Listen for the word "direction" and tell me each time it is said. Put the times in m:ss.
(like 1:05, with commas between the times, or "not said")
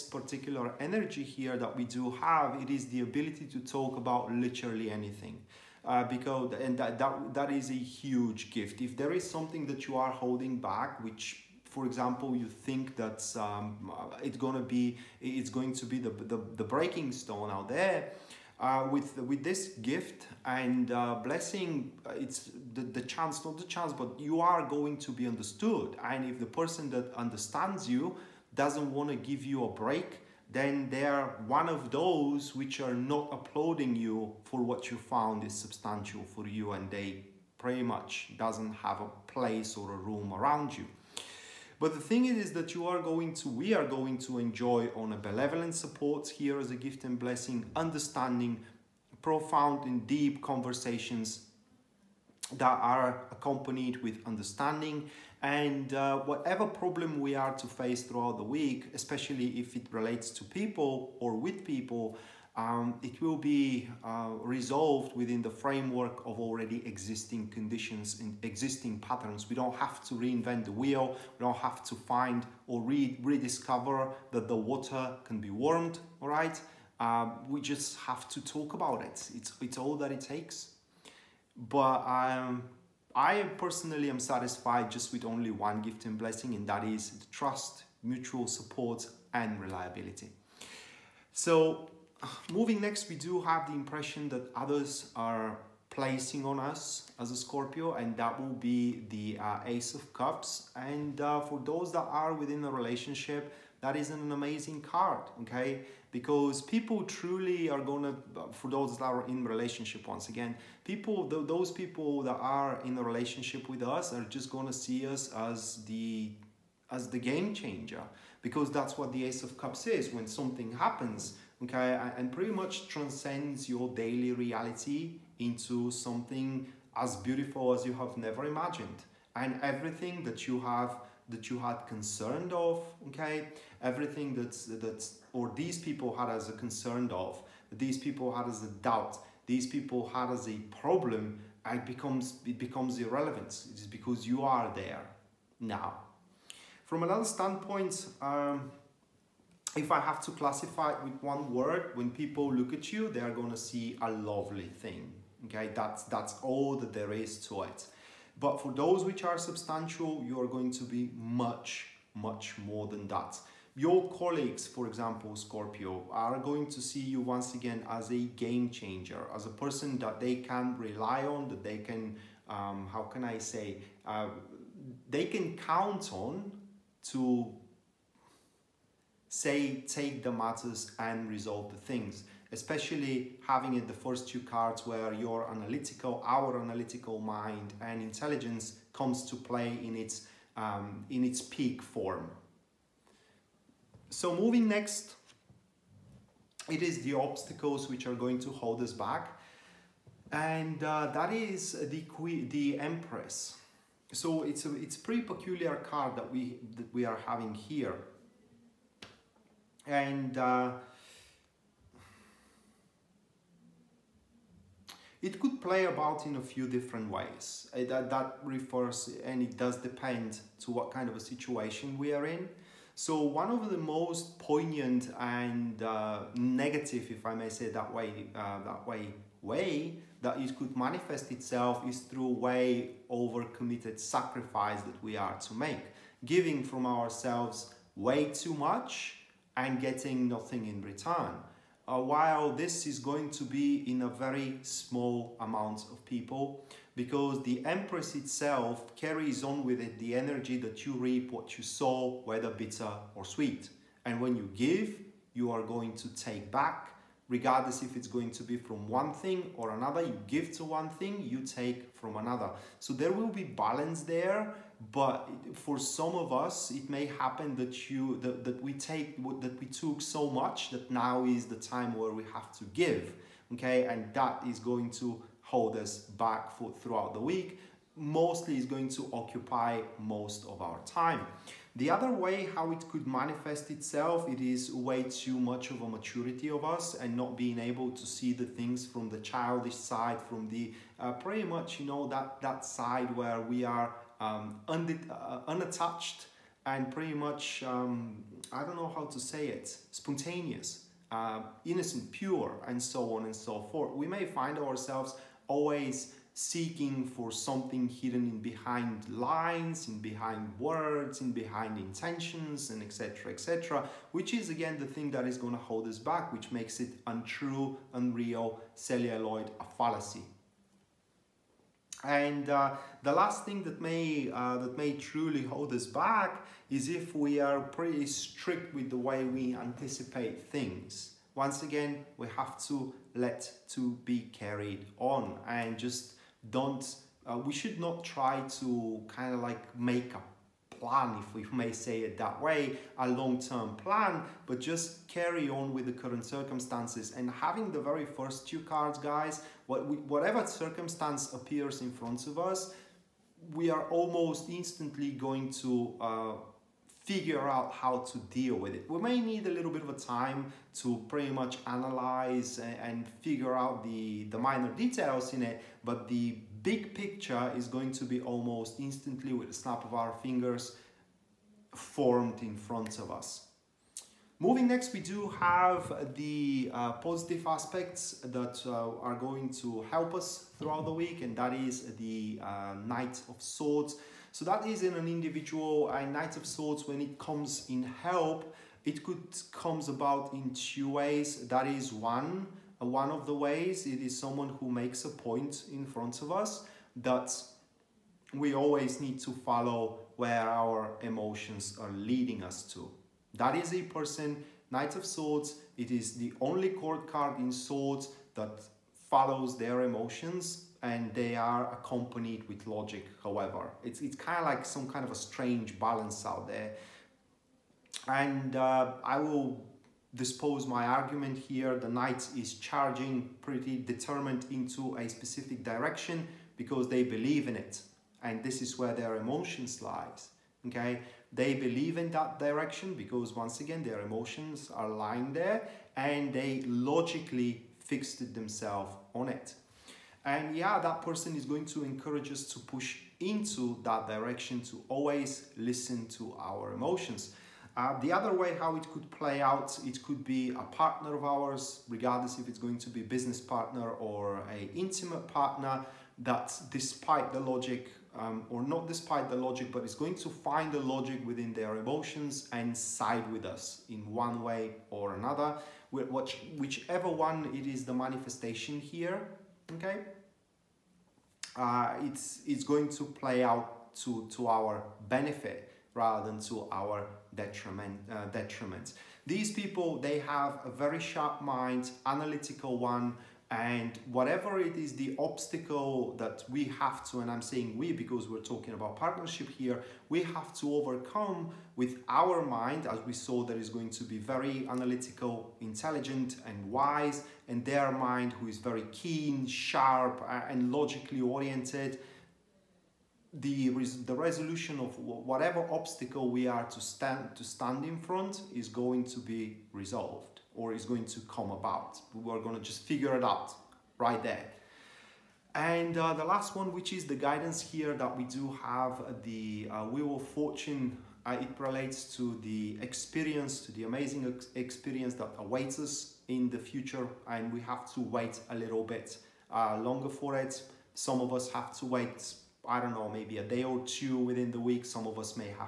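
7:05, 7:12, 7:24.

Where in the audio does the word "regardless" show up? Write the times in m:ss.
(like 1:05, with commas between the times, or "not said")
4:17, 7:31.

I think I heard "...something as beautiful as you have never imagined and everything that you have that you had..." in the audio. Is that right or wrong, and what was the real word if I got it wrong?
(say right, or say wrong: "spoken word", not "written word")
right.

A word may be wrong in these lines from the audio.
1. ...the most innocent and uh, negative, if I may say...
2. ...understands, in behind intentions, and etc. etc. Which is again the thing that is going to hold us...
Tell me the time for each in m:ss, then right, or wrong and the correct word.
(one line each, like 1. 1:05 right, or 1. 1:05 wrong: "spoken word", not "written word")
1. 3:43 wrong: "poignant", not "innocent"
2. 5:10 wrong: "words", not "understands".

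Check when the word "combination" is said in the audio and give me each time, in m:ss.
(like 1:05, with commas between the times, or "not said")
not said.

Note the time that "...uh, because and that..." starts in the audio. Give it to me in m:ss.
0:05.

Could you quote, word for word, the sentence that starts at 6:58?
And uh, I will dispose my argument here.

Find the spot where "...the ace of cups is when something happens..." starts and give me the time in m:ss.
1:59.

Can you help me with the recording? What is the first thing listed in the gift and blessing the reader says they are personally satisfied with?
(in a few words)
Trust.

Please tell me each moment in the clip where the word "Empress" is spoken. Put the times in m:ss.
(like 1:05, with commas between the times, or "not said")
3:22, 4:07.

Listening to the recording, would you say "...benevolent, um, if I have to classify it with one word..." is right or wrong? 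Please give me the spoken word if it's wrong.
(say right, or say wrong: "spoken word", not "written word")
wrong: "standpoint", not "benevolent".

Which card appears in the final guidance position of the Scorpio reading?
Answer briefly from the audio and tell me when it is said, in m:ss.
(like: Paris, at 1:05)
Wheel of Fortune, at 8:39.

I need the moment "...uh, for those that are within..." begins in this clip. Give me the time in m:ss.
1:41.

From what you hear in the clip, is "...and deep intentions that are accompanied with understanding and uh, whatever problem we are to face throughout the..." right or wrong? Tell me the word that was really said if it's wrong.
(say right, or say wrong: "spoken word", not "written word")
wrong: "conversations", not "intentions".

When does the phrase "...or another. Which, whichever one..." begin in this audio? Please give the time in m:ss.
7:44.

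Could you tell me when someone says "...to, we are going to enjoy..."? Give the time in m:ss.
0:43.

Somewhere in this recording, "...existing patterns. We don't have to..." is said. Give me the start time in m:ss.
1:08.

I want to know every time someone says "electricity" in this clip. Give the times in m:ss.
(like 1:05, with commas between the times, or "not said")
not said.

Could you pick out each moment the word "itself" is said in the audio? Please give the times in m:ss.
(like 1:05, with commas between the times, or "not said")
3:51, 4:08, 4:43.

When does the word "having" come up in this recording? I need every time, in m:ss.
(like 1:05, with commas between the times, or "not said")
3:03, 3:27, 5:47.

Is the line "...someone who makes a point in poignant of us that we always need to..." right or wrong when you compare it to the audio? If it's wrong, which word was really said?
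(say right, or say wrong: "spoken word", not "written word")
wrong: "front", not "poignant".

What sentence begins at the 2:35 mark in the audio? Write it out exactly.
Okay, that's, that's all that there is to it.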